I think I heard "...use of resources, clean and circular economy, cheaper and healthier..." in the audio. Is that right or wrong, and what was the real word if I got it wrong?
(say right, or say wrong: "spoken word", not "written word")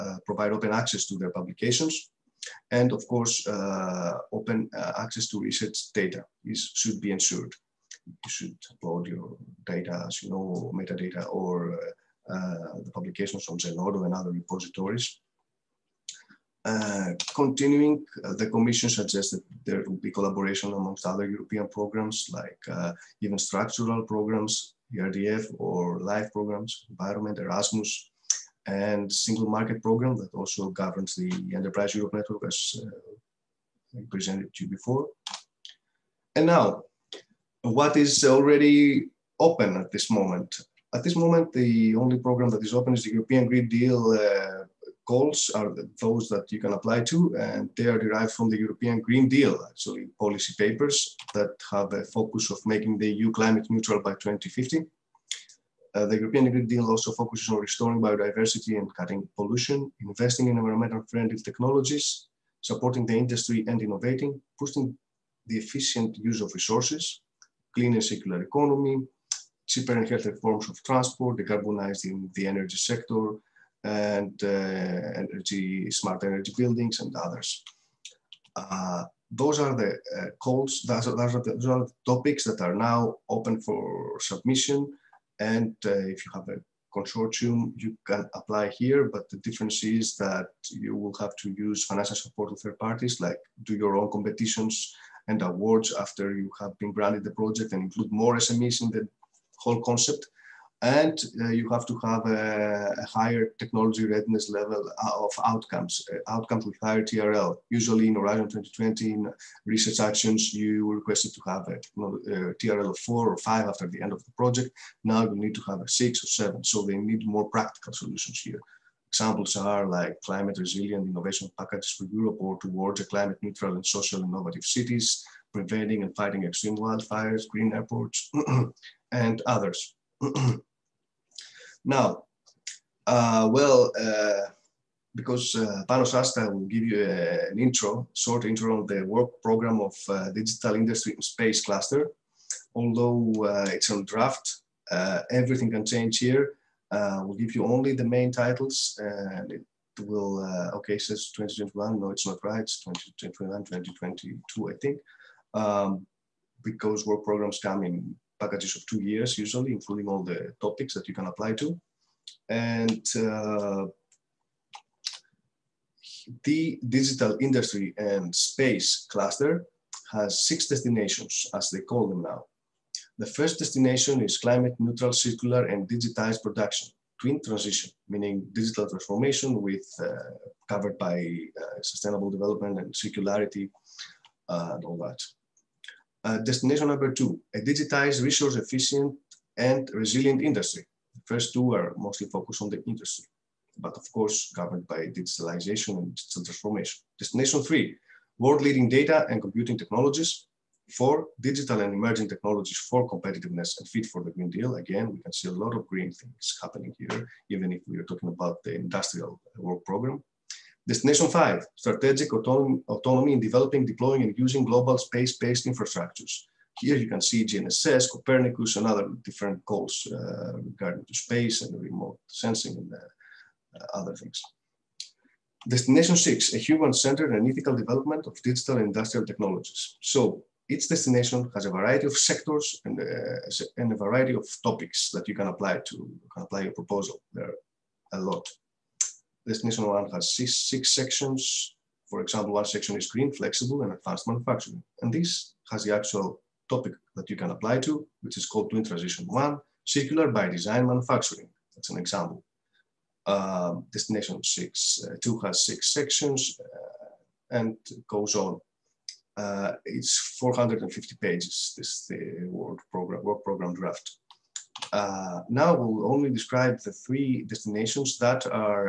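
right.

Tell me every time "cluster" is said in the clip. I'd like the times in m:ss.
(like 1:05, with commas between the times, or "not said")
2:21, 2:49.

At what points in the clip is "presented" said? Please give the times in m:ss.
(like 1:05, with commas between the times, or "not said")
0:34.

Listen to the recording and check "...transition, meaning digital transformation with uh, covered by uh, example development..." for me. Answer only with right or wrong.
wrong.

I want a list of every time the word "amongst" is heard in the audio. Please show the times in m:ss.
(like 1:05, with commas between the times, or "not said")
0:20.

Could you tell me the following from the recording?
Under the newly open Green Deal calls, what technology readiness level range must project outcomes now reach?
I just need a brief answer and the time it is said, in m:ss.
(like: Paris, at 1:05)
6 or 7, at 1:55.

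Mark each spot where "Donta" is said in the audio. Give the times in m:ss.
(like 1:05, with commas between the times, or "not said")
not said.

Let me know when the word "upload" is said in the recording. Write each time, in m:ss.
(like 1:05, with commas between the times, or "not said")
0:08.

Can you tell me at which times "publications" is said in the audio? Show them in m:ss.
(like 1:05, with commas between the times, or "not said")
0:01, 0:12.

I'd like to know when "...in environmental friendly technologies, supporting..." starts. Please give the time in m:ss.
1:00.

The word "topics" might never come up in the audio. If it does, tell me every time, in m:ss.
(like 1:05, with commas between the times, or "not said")
1:22, 2:40, 3:54, 4:06.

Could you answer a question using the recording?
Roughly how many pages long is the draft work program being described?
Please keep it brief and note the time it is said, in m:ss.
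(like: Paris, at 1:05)
450, at 4:20.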